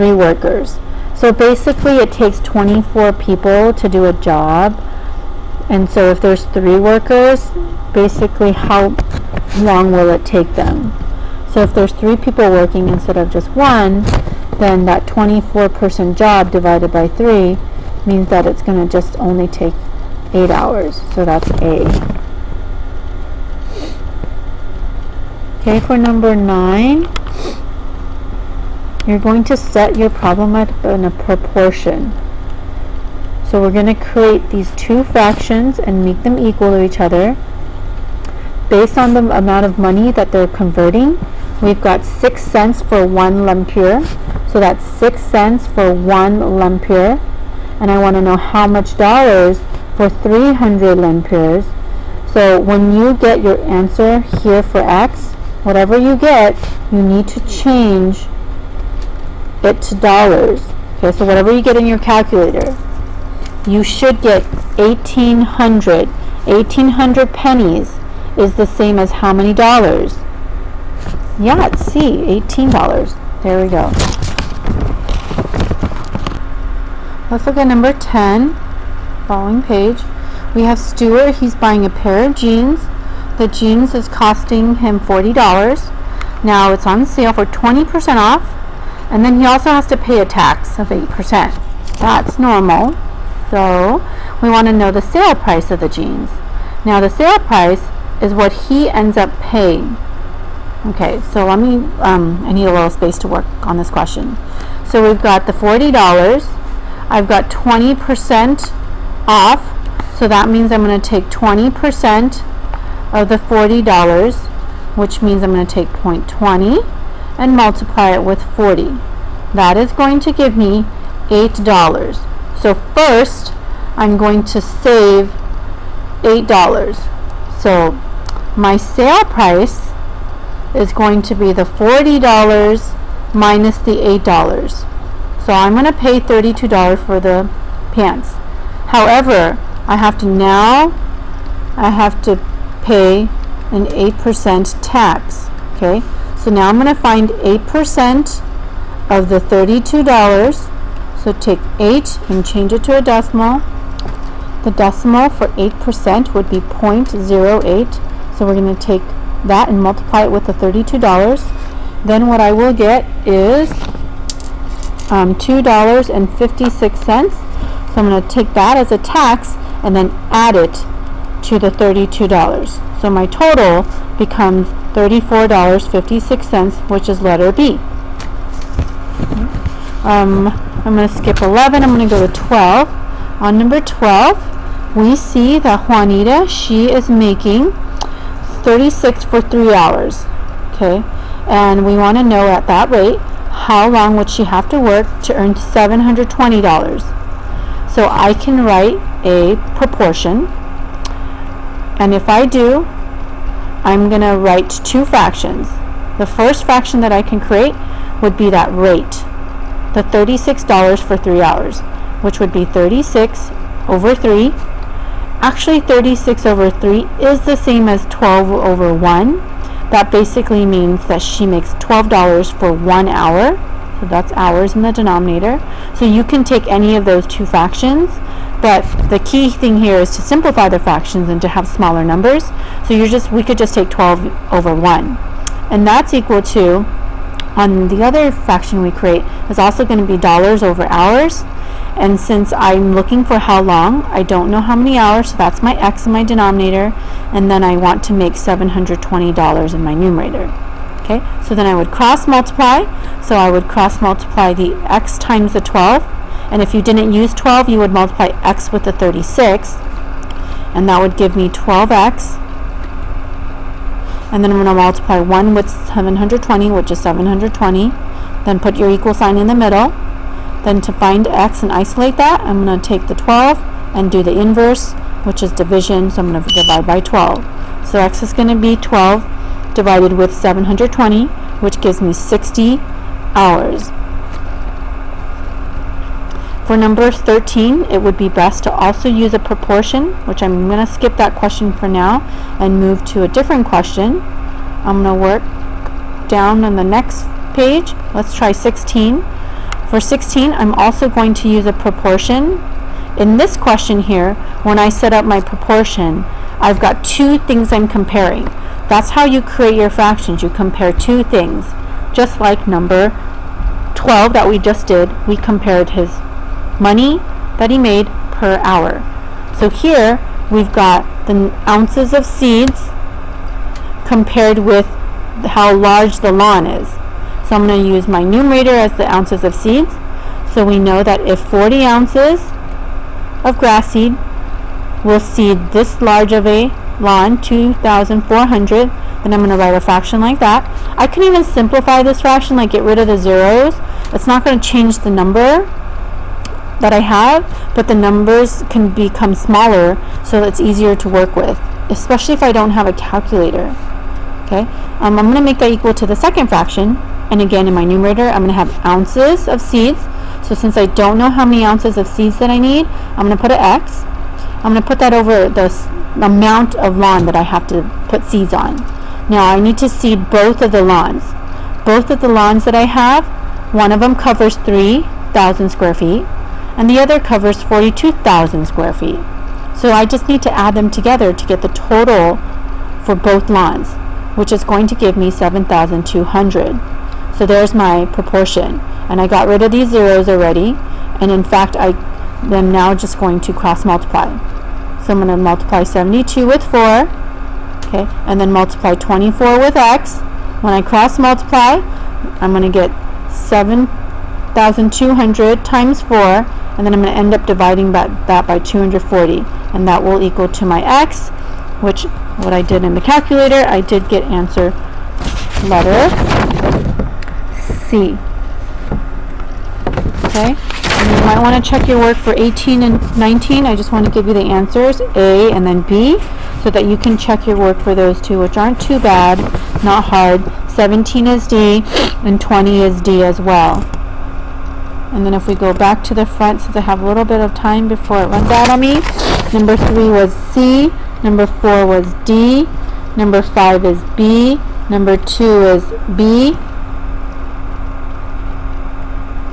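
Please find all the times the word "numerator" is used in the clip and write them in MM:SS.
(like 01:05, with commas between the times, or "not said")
04:09, 05:28, 05:57.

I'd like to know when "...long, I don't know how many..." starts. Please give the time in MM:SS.
04:03.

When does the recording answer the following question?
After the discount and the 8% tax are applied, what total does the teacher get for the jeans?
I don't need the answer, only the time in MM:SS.
02:54.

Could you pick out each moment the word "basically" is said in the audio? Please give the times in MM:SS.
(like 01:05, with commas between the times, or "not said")
00:01, 00:07, 03:40.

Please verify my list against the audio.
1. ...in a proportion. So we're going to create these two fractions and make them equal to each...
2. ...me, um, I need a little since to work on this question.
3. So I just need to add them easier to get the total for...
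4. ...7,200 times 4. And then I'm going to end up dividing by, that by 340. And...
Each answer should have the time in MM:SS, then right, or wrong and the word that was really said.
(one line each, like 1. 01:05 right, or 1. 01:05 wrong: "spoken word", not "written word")
1. 00:30 right
2. 01:41 wrong: "space", not "since"
3. 06:19 wrong: "together", not "easier"
4. 06:43 wrong: "240", not "340".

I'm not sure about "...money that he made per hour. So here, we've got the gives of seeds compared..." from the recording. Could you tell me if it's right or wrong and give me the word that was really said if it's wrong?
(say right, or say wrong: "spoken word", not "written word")
wrong: "ounces", not "gives".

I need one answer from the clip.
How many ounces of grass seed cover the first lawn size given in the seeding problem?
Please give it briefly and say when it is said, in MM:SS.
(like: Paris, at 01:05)
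40 ounces, at 05:31.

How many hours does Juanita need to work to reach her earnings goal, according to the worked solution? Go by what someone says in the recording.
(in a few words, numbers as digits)
60 hours.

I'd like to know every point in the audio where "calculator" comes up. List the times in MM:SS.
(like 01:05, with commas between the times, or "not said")
01:01, 05:52, 06:53.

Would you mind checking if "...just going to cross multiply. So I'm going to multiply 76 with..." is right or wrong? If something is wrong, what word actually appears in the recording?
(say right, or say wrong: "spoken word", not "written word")
wrong: "72", not "76".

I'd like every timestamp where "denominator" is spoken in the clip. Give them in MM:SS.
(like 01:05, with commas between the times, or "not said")
03:44, 04:06.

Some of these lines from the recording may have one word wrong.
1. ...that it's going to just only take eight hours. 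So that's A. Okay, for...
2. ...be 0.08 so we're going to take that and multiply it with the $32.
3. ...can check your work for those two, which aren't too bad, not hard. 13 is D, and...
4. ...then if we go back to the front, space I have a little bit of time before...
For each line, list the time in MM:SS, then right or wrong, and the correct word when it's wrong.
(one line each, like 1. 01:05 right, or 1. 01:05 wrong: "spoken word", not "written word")
1. 00:18 right
2. 02:36 right
3. 07:06 wrong: "17", not "13"
4. 07:15 wrong: "since", not "space".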